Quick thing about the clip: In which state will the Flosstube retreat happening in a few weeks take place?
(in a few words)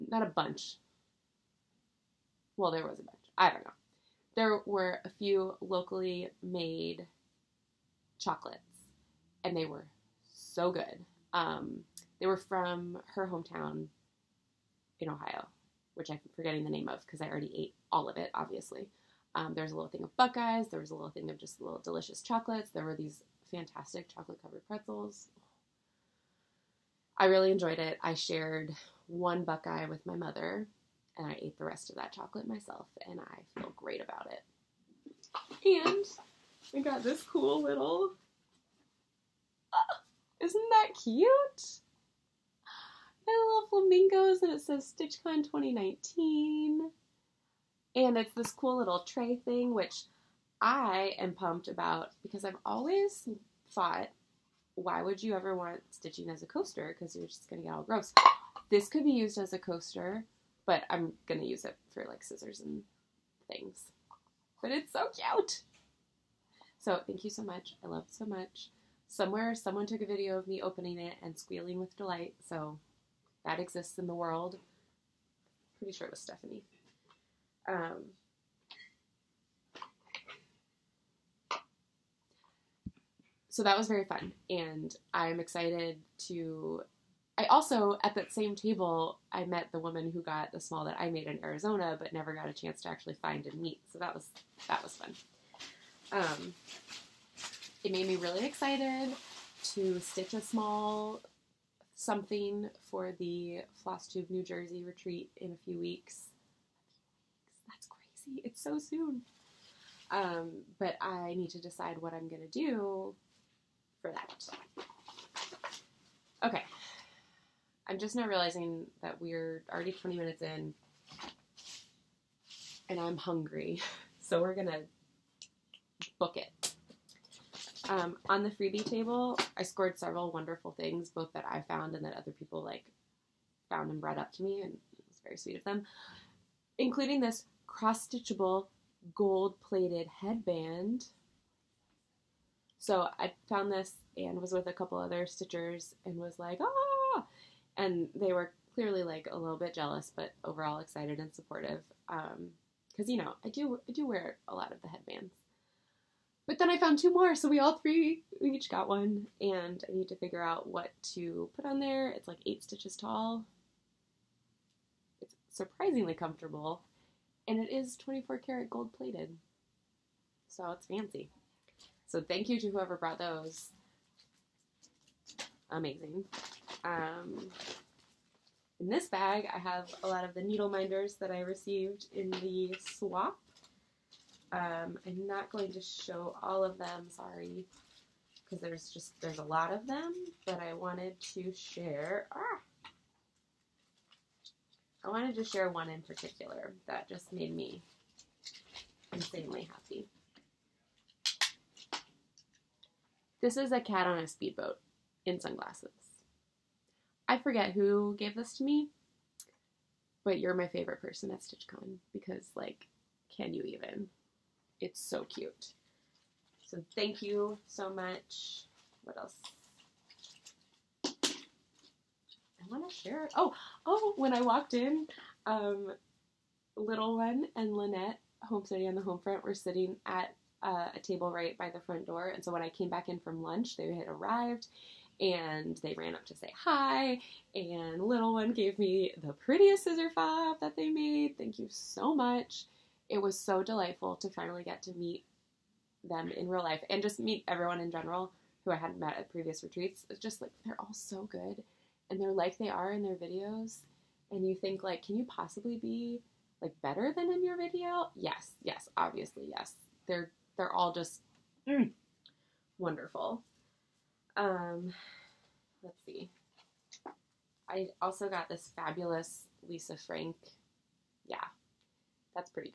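New Jersey.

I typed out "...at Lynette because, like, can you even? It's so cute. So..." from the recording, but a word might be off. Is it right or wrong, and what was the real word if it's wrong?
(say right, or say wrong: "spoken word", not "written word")
wrong: "StitchCon", not "Lynette".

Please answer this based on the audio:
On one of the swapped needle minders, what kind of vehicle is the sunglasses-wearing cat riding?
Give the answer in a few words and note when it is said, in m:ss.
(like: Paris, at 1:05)
speedboat, at 3:24.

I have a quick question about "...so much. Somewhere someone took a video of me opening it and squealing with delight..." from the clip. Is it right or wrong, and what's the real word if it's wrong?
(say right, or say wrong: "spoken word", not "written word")
right.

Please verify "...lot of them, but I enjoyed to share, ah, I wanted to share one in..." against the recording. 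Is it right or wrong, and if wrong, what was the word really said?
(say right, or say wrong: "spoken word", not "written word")
wrong: "wanted", not "enjoyed".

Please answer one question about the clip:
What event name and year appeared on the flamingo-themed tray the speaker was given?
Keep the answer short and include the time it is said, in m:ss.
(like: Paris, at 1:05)
StitchCon 2019, at 0:44.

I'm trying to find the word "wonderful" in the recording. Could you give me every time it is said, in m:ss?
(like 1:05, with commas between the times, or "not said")
2:10, 4:22.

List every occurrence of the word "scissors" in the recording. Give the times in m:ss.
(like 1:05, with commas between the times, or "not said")
1:02, 3:59.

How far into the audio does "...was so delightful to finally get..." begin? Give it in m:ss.
4:03.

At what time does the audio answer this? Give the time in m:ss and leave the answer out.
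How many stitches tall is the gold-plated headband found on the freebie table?
2:42.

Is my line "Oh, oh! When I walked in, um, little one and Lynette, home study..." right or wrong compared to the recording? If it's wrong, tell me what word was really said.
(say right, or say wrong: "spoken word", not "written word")
right.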